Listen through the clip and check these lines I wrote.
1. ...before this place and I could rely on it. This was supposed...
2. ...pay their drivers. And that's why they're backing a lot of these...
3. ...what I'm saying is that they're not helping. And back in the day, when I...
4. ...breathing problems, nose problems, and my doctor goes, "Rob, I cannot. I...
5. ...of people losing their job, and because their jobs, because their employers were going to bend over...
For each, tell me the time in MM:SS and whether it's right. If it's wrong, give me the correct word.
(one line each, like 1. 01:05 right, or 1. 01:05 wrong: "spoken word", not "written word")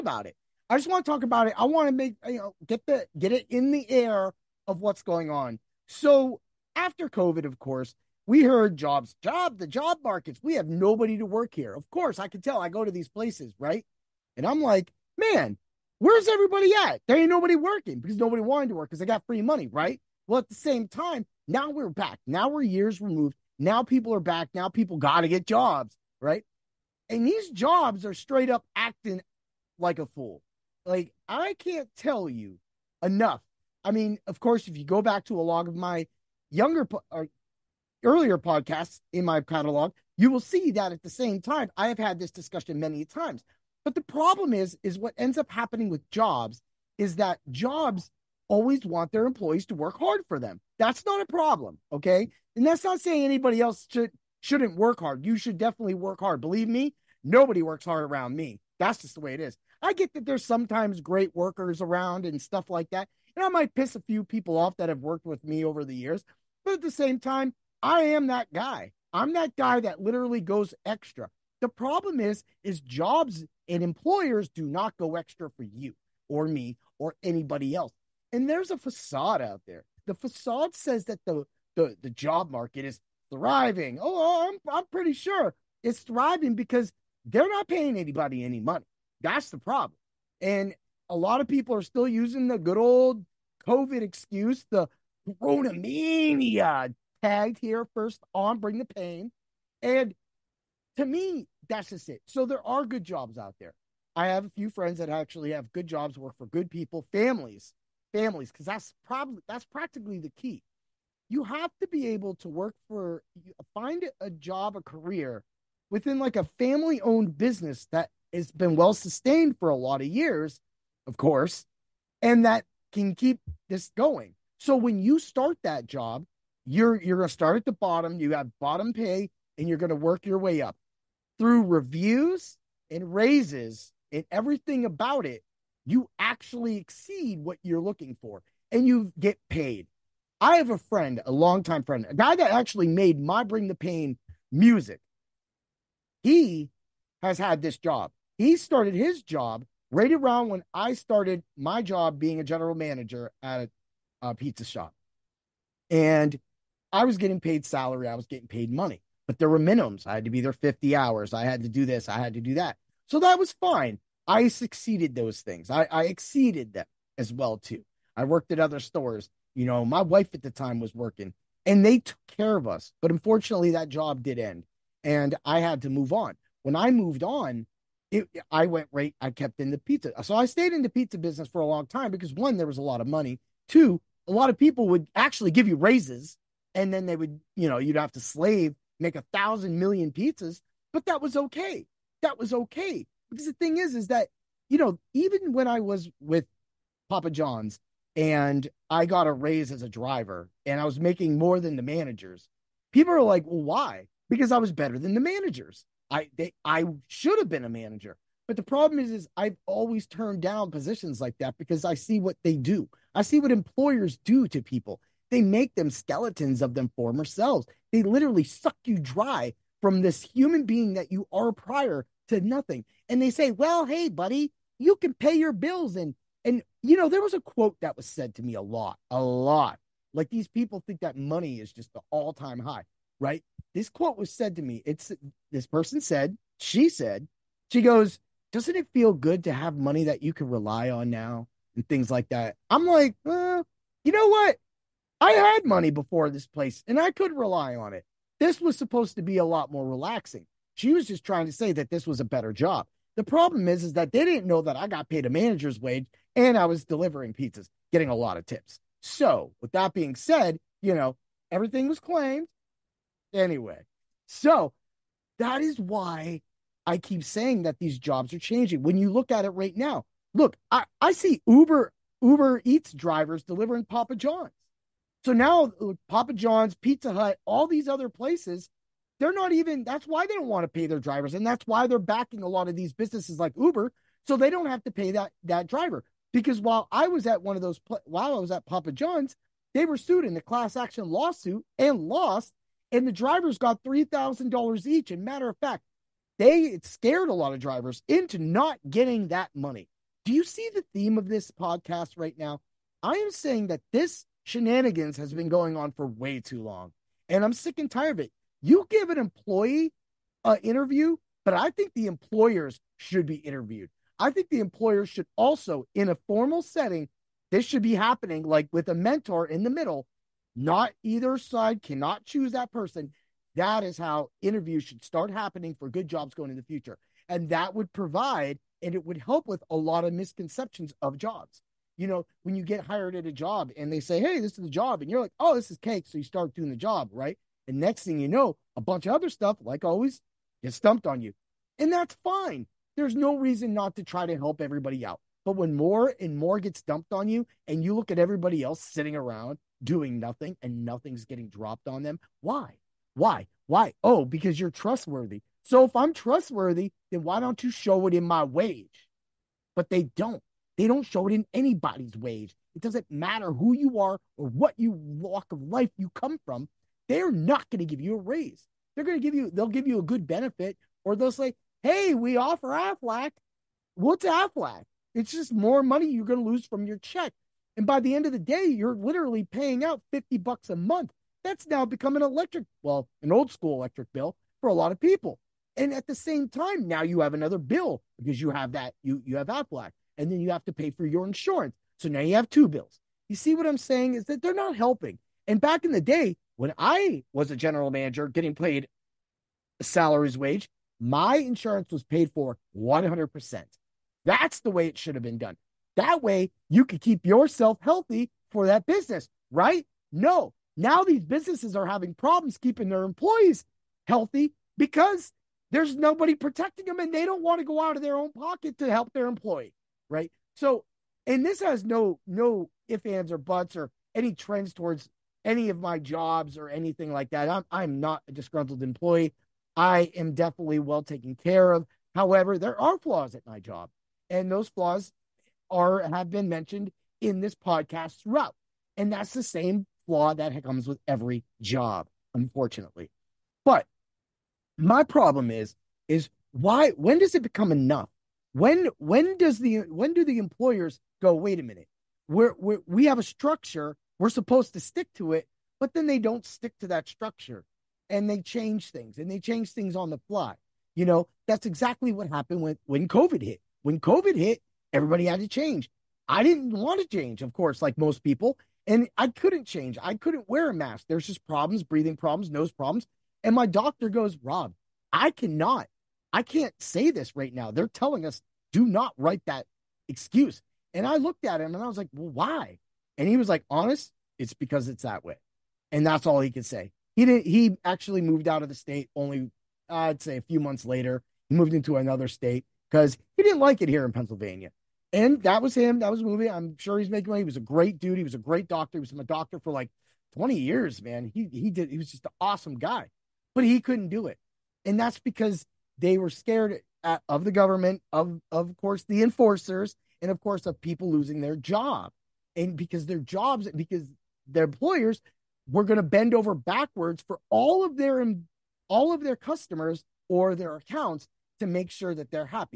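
1. 04:05 right
2. 04:40 right
3. 06:33 right
4. 07:51 right
5. 08:30 right.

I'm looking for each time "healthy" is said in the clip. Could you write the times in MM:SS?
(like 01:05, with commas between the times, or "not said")
06:47, 06:54.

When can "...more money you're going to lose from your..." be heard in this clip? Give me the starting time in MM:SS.
06:15.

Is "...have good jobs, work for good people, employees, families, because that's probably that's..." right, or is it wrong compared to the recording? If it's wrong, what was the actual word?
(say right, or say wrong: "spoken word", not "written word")
wrong: "families", not "employees".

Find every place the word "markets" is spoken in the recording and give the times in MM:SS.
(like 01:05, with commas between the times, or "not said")
00:10, 01:22.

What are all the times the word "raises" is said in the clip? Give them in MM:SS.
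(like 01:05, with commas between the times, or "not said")
02:13, 03:05, 03:19, 06:08.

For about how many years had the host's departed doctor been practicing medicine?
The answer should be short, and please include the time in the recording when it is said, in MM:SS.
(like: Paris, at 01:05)
20 years, at 08:20.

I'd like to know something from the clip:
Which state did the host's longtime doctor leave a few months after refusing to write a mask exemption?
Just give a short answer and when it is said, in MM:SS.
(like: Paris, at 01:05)
Pennsylvania, at 08:14.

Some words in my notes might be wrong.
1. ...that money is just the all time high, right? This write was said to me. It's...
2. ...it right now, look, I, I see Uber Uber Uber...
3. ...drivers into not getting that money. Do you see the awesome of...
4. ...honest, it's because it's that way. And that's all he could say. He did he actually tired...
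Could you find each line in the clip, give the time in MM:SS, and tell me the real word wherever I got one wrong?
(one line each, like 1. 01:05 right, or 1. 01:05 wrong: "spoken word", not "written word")
1. 03:51 wrong: "quote", not "write"
2. 04:29 wrong: "Eats", not "Uber"
3. 04:57 wrong: "theme", not "awesome"
4. 08:03 wrong: "moved", not "tired".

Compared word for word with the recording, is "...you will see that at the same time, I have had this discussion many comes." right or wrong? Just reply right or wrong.
wrong.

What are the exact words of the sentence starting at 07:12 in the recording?
However, there are flaws at my job, and those flaws are have been mentioned in this podcast throughout.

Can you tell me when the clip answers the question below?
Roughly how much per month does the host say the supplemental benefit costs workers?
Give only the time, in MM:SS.
06:20.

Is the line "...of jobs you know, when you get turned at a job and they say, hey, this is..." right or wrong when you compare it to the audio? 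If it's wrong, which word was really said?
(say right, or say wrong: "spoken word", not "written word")
wrong: "hired", not "turned".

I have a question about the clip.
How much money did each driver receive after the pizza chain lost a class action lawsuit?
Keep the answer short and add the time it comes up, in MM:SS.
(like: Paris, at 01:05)
$3,000, at 04:53.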